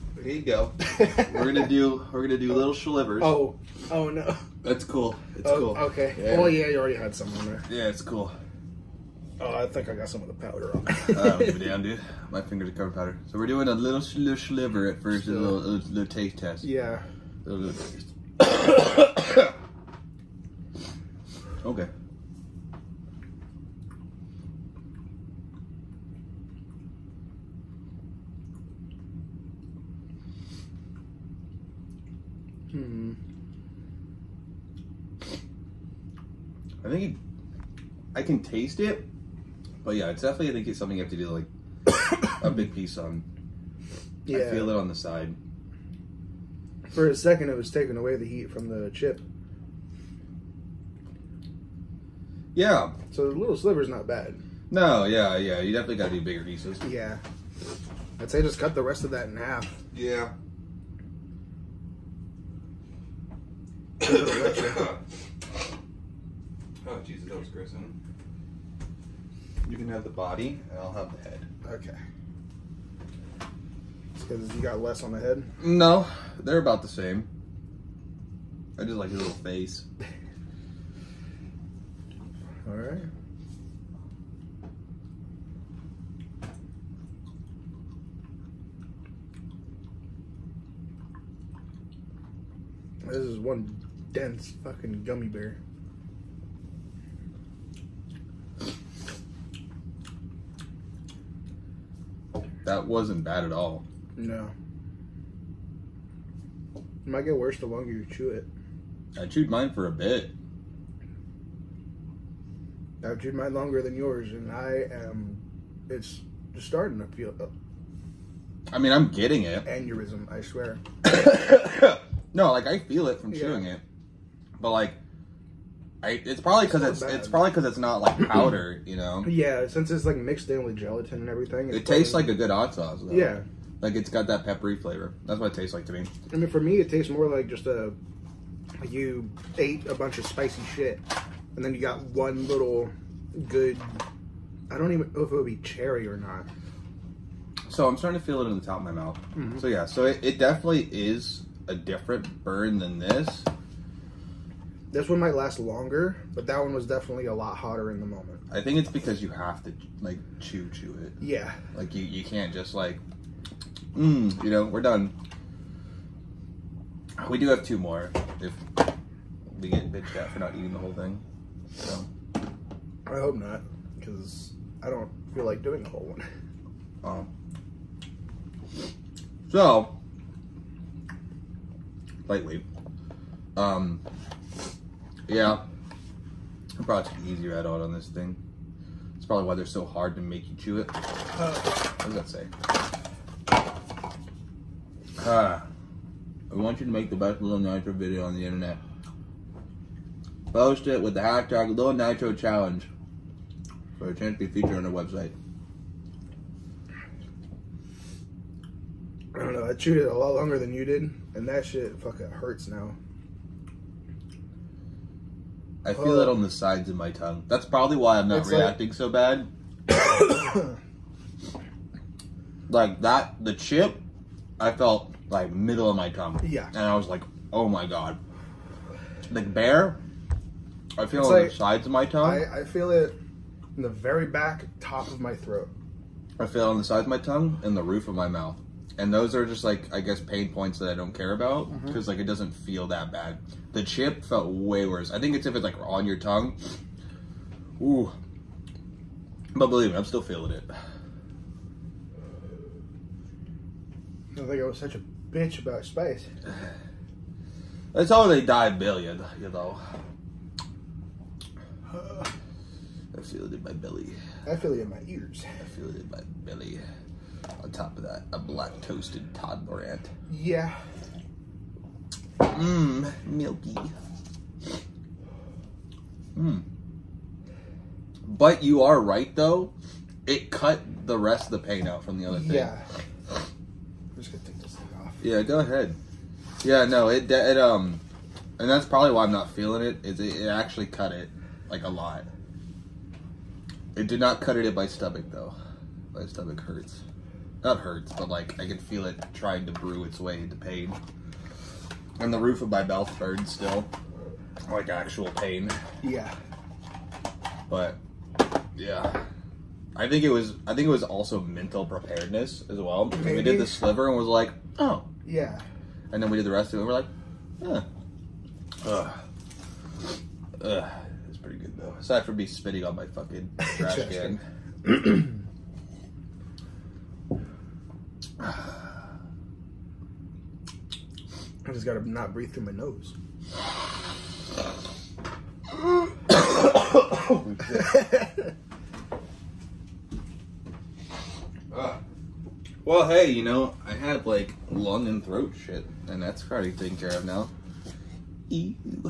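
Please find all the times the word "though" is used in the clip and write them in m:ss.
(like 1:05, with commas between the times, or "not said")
2:13, 4:39, 4:55, 5:21.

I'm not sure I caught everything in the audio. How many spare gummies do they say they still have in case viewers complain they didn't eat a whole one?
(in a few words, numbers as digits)
2.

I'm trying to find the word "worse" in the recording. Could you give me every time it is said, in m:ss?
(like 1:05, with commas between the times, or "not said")
1:47, 4:04.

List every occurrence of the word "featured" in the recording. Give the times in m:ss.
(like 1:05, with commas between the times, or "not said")
3:24.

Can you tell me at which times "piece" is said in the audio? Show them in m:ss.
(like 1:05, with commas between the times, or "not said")
0:42, 0:56.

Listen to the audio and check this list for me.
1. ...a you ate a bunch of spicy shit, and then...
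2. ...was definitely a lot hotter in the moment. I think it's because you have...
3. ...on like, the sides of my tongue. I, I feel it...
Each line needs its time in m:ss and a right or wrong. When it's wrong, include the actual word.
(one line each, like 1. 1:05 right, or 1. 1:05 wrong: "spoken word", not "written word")
1. 2:17 right
2. 2:36 right
3. 3:51 right.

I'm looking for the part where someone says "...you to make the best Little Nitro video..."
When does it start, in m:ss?
3:16.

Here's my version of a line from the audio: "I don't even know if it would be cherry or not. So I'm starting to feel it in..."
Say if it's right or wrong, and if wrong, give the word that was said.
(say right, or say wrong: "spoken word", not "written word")
right.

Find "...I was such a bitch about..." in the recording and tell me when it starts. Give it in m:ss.
4:14.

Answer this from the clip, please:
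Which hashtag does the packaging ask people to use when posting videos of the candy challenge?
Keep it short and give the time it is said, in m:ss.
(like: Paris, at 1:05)
Little Nitro Challenge, at 3:21.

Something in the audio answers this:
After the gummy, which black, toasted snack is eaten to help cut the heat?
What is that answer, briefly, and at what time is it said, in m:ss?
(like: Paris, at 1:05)
Todd ant, at 4:29.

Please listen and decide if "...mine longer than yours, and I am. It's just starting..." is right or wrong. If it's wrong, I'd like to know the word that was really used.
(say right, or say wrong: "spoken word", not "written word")
right.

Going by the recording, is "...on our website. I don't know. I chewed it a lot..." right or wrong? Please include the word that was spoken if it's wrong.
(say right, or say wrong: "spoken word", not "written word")
right.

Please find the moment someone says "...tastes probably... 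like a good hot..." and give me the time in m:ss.
2:11.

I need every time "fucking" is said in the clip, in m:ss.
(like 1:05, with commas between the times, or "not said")
1:34, 3:32, 5:23.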